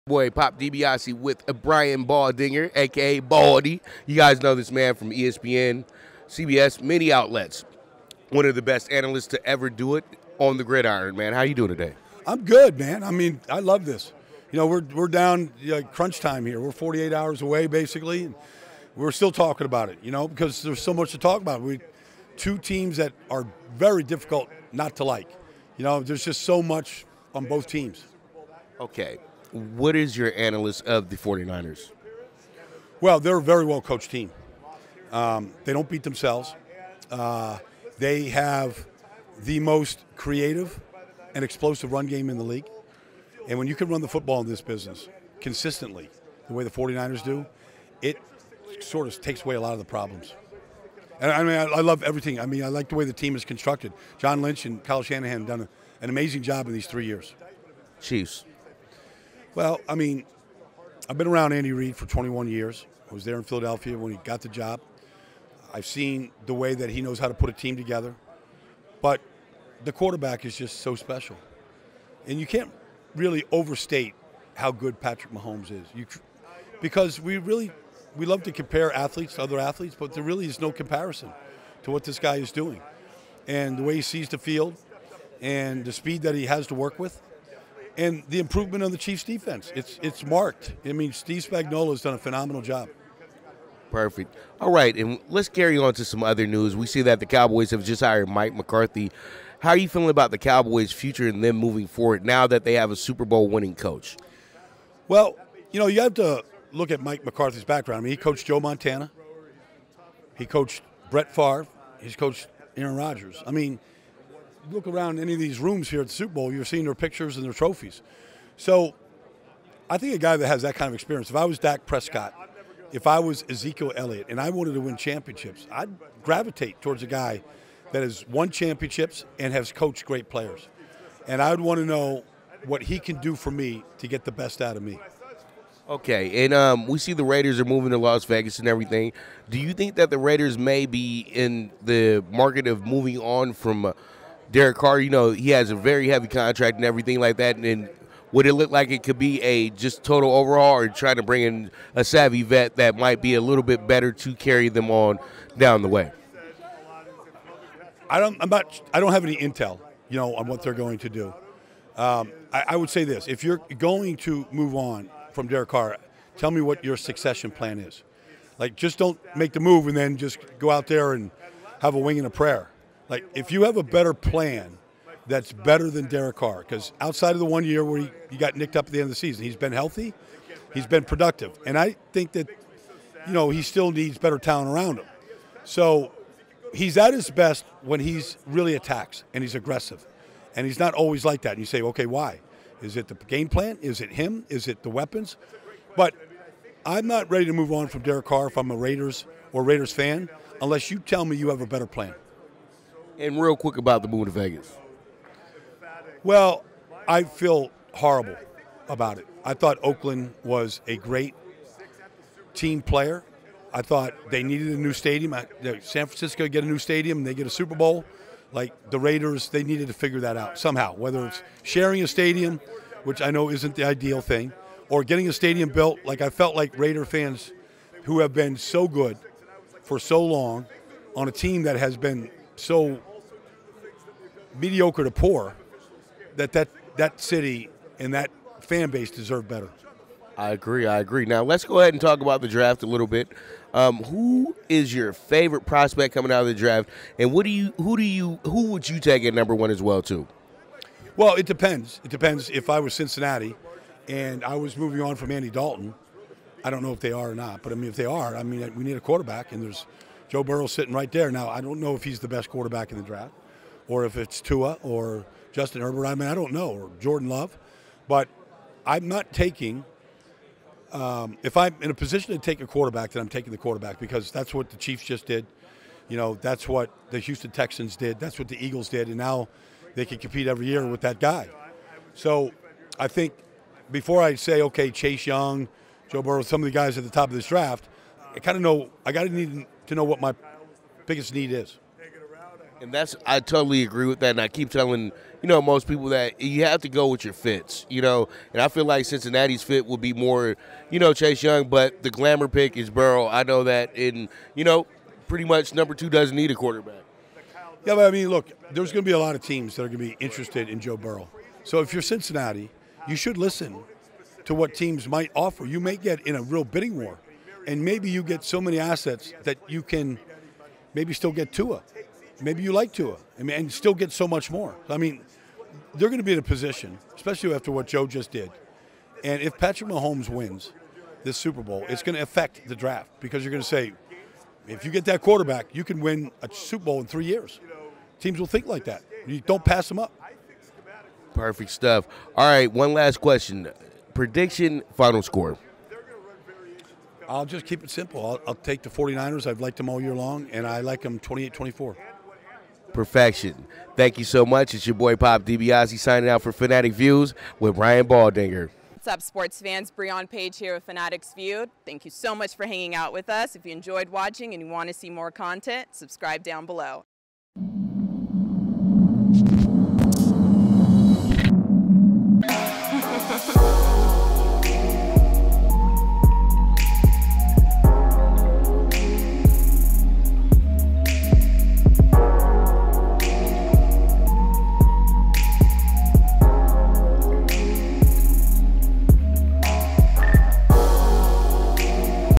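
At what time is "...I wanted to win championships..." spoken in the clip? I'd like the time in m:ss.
2:04.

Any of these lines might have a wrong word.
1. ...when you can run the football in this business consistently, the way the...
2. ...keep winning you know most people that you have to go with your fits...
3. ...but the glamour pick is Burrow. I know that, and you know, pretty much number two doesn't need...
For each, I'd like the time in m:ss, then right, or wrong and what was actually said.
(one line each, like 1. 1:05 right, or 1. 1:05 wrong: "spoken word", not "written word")
1. 0:43 right
2. 4:54 wrong: "telling", not "winning"
3. 5:01 right.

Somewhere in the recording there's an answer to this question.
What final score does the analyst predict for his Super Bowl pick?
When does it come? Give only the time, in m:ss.
5:51.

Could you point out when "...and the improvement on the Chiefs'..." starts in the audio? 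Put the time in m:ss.
1:27.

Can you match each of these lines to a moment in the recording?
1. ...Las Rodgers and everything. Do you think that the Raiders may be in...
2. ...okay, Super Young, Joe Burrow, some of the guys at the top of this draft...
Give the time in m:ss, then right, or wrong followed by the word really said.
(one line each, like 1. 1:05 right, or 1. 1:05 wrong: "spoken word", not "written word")
1. 2:17 wrong: "Vegas", not "Rodgers"
2. 4:44 wrong: "Chase", not "Super".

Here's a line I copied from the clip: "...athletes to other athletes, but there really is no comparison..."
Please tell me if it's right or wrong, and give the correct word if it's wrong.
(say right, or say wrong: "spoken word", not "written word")
right.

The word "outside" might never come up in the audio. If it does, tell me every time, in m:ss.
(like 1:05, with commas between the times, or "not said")
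2:56.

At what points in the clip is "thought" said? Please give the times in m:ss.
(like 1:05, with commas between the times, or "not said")
3:29, 3:33.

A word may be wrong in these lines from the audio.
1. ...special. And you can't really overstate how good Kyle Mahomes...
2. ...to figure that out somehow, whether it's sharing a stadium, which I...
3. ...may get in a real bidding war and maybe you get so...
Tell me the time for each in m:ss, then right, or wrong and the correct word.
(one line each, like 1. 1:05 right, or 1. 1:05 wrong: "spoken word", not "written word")
1. 1:10 wrong: "Patrick", not "Kyle"
2. 3:39 right
3. 5:15 right.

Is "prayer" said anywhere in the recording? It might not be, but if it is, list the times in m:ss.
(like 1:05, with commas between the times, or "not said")
2:52.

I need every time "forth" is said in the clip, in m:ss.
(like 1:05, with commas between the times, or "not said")
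not said.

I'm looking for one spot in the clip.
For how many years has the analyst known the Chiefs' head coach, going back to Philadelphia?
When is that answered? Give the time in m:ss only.
1:02.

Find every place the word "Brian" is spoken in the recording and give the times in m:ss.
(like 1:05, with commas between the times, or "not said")
0:01, 5:57.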